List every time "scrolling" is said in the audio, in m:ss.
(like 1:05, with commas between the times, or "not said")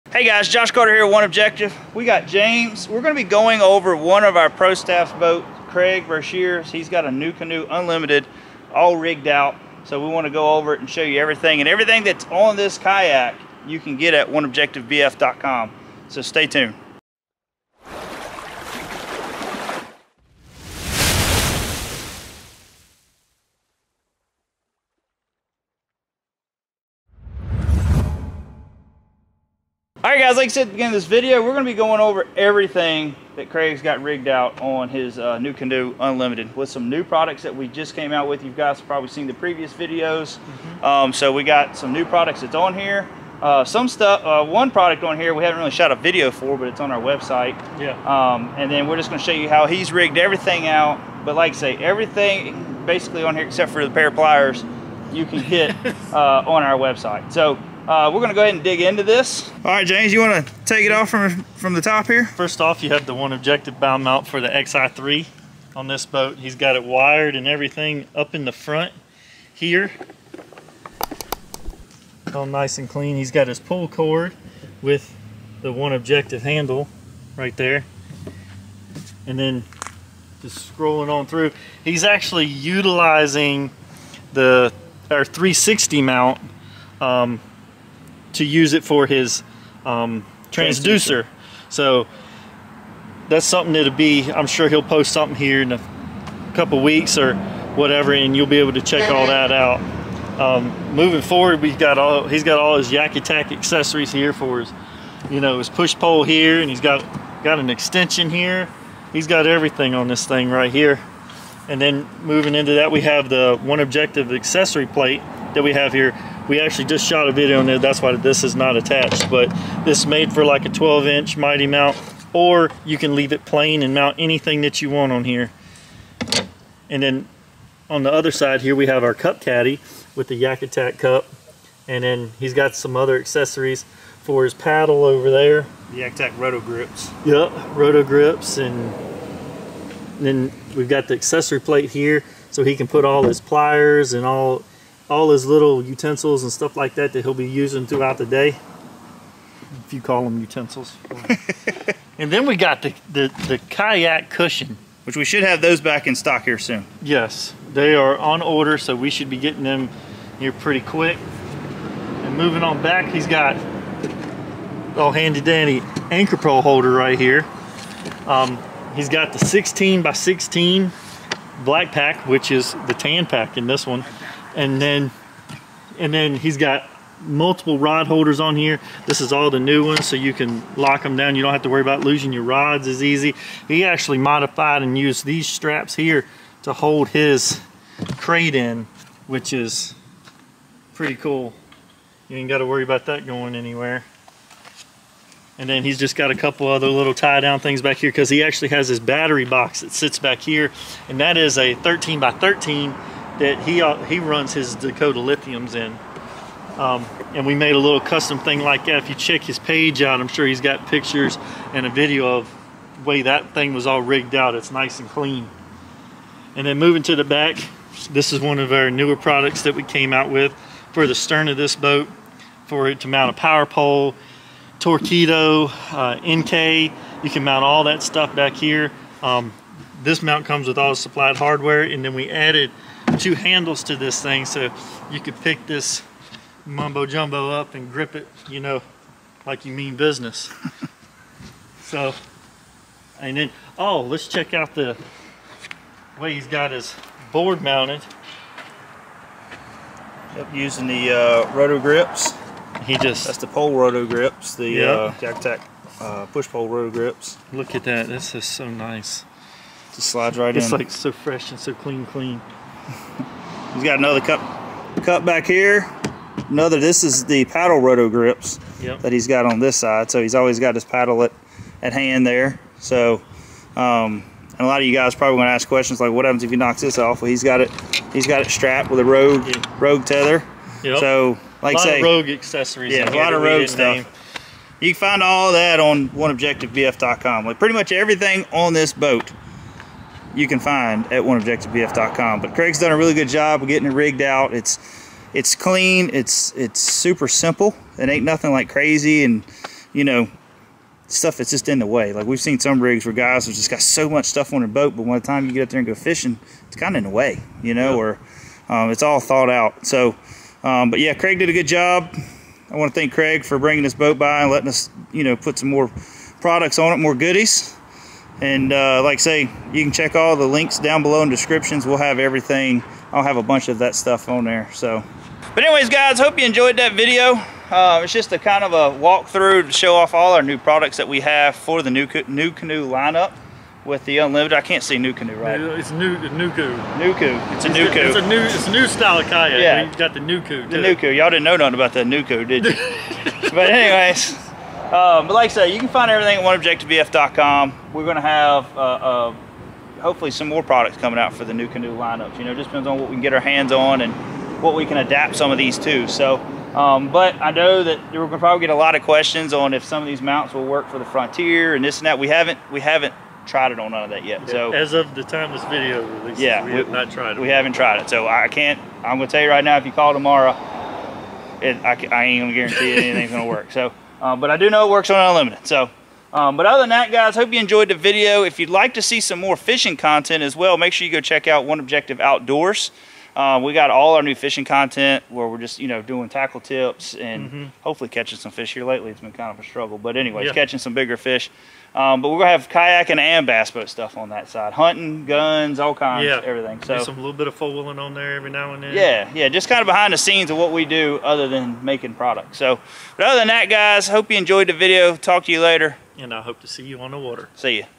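1:20.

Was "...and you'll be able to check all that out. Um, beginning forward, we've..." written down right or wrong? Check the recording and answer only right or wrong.
wrong.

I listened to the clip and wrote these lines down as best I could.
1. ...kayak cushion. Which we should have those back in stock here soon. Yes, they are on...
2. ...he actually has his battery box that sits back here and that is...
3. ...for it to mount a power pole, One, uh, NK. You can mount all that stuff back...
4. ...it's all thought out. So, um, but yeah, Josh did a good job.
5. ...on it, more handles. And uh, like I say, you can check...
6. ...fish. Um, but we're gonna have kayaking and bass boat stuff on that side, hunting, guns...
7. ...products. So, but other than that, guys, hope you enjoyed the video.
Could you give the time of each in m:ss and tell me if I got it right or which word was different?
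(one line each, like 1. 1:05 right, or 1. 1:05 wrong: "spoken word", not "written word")
1. 2:33 right
2. 3:18 right
3. 3:42 wrong: "Torqeedo", not "One"
4. 5:08 wrong: "Craig", not "Josh"
5. 5:16 wrong: "goodies", not "handles"
6. 6:31 right
7. 6:42 right.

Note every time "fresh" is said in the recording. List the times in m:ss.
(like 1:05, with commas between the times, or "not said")
4:21.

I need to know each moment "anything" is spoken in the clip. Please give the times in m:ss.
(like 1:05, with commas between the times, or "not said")
2:04, 6:13.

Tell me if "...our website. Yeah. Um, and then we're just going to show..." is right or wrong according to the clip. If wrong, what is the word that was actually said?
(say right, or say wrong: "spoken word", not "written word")
right.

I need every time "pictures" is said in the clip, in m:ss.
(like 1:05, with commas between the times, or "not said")
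3:30.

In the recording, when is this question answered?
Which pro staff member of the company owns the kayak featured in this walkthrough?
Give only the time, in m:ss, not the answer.
0:05.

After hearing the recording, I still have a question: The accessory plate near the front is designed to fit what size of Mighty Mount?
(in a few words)
12 inch.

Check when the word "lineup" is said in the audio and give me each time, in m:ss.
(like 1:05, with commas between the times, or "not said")
5:32, 5:51.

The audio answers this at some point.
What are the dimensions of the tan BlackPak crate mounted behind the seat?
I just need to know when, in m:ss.
2:49.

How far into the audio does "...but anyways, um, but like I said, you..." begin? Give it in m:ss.
5:43.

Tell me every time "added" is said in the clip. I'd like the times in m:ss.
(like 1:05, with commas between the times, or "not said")
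3:52.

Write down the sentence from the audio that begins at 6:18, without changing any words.
If you'd like to see some more fishing content as well, make sure you go check out One Objective Outdoors.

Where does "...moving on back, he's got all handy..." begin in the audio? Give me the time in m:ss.
2:42.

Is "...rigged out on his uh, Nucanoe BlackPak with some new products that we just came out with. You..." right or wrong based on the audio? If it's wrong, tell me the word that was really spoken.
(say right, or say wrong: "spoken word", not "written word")
wrong: "Unlimited", not "BlackPak".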